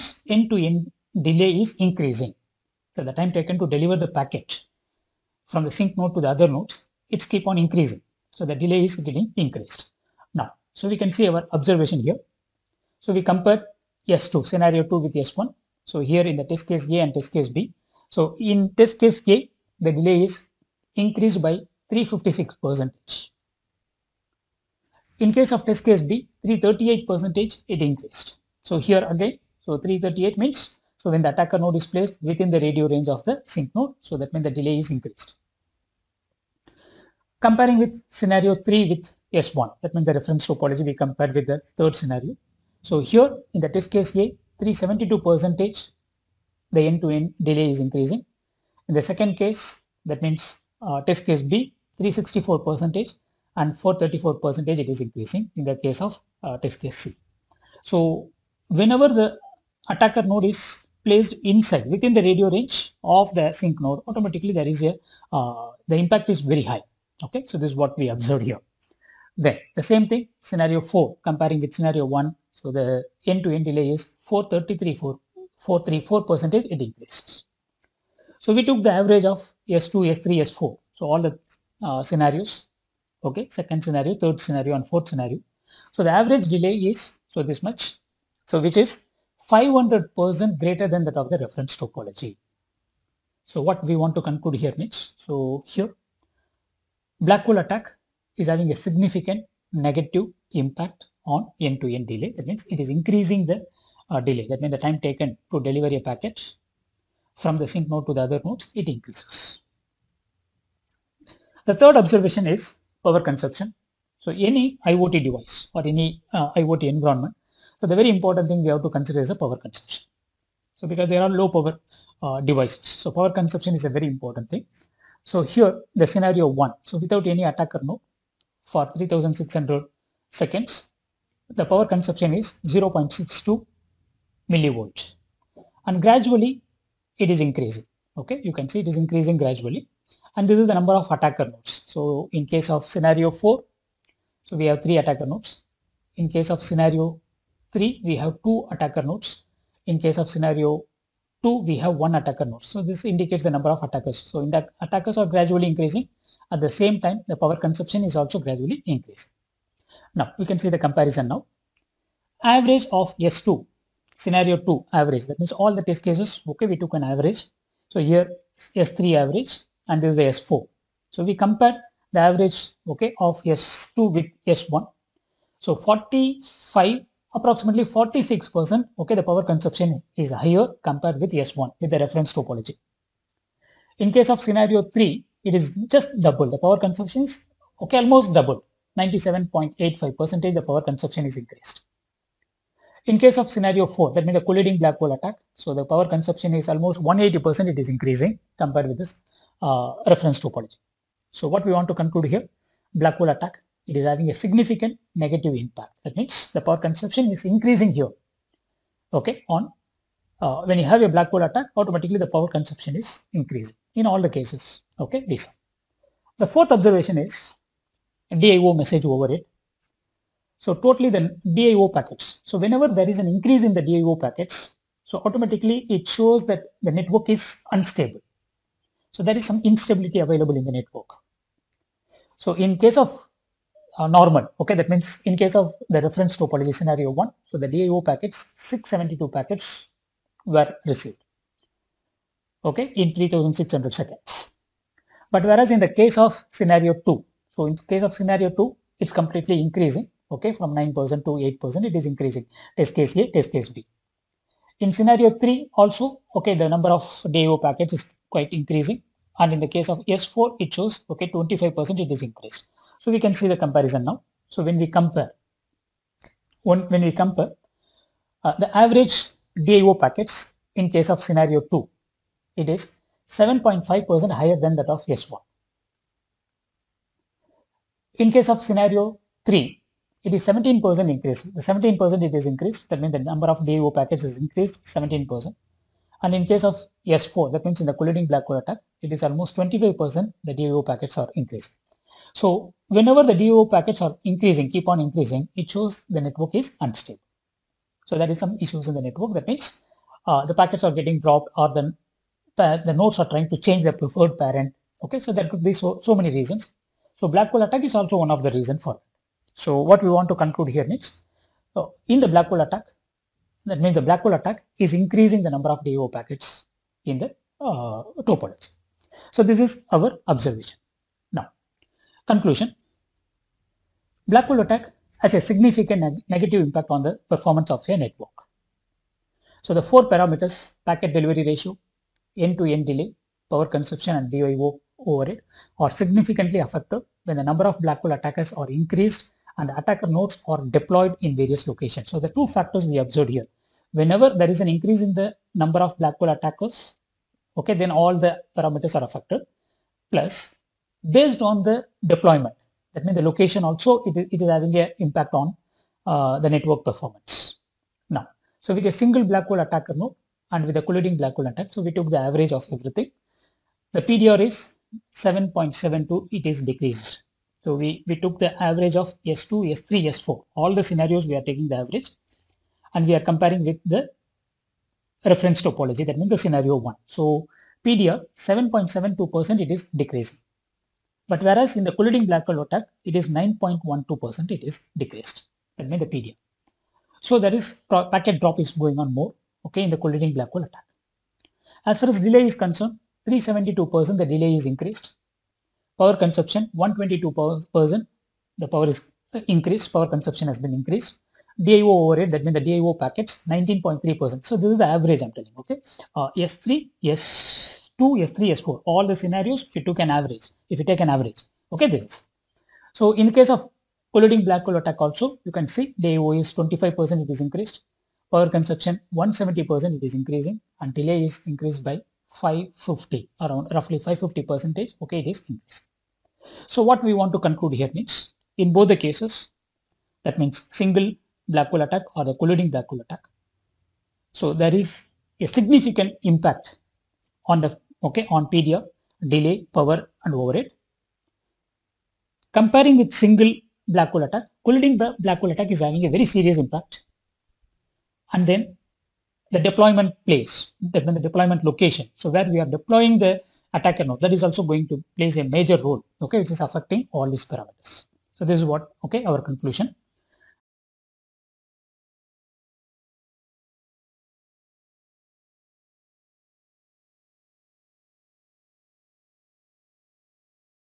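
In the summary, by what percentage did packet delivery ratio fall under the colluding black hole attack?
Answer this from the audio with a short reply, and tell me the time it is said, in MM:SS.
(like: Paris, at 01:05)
9.12%, at 06:23.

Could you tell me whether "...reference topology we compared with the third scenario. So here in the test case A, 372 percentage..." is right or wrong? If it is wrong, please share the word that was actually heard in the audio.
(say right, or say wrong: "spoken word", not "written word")
right.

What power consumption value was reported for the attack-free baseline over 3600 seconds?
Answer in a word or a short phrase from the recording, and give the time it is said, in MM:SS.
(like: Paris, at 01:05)
0.62 millivolt, at 02:12.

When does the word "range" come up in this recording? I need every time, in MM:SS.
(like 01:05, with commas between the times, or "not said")
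00:32, 01:02.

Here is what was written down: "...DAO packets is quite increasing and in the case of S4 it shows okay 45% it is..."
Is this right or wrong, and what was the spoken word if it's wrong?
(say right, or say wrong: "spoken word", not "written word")
wrong: "25", not "45".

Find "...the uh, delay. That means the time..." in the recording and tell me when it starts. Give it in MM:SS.
01:43.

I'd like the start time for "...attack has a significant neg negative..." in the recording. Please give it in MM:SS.
05:24.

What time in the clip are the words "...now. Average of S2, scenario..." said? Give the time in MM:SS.
02:41.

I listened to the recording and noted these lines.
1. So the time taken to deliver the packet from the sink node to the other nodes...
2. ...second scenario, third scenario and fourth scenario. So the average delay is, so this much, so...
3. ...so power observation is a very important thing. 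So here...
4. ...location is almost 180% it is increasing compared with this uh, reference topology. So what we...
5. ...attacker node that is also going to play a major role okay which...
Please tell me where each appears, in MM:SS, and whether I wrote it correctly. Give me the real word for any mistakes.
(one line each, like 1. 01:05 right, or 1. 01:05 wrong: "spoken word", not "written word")
1. 00:02 right
2. 01:23 right
3. 02:03 wrong: "consumption", not "observation"
4. 03:16 wrong: "consumption", not "location"
5. 07:33 right.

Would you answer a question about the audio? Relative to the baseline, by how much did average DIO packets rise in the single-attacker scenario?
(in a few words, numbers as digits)
7.5%.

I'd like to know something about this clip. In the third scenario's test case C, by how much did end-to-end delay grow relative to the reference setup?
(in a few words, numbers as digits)
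434%.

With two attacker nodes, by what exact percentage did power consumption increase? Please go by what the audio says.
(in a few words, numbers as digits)
97.85%.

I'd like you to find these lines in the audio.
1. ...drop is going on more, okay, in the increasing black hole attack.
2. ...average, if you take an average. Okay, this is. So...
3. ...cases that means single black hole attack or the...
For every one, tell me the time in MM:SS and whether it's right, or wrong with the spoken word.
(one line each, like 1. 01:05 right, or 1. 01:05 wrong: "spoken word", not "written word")
1. 06:28 wrong: "colliding", not "increasing"
2. 06:50 right
3. 07:08 right.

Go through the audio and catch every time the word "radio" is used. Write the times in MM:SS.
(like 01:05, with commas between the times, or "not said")
00:32, 01:02.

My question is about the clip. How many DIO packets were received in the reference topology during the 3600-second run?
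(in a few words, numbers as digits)
672.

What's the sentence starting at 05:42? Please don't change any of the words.
So the two factors we observed here.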